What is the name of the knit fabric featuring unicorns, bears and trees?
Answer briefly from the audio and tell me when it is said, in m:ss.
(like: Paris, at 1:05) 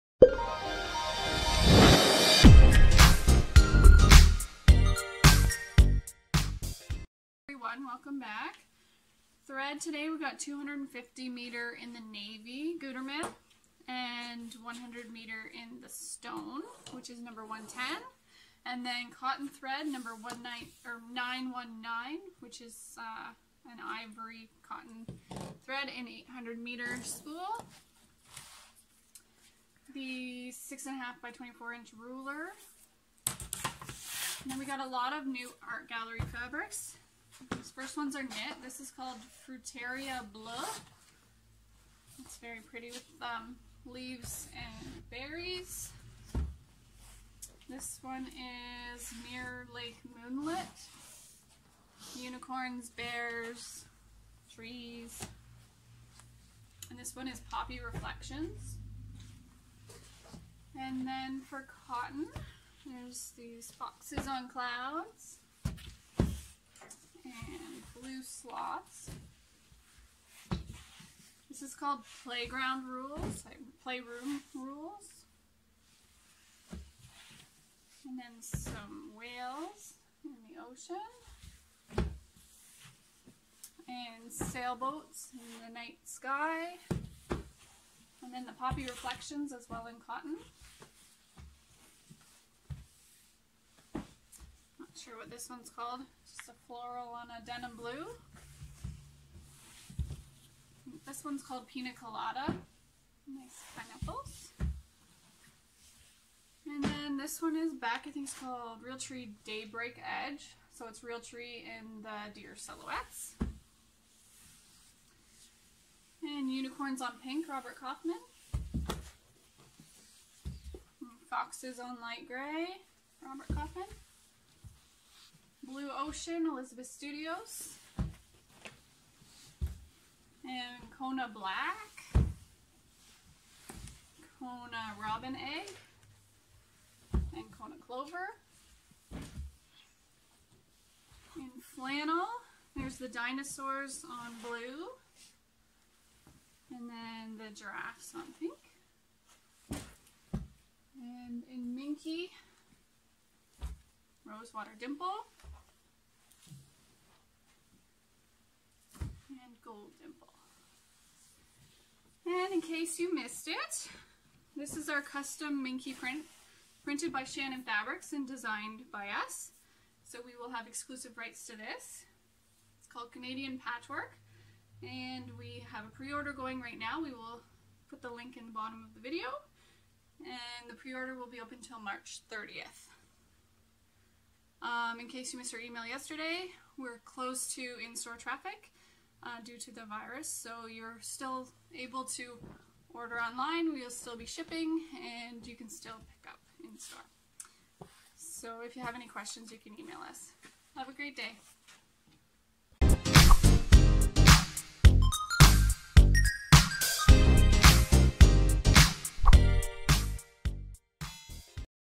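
Mirror Lake Moonlit, at 0:49.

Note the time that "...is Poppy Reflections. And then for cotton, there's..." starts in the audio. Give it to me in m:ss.
0:57.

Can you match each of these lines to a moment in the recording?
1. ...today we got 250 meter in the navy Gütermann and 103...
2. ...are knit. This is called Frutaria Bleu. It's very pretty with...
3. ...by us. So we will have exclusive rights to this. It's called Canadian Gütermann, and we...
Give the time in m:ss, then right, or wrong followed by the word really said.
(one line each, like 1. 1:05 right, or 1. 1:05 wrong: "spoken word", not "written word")
1. 0:09 wrong: "100", not "103"
2. 0:38 right
3. 2:48 wrong: "Patchwork", not "Gütermann".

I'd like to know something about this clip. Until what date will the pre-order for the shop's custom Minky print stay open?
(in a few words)
March 30th.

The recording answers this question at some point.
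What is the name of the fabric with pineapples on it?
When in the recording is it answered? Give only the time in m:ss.
1:41.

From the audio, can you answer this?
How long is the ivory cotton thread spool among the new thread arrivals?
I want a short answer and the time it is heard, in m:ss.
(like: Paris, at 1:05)
800 meter, at 0:26.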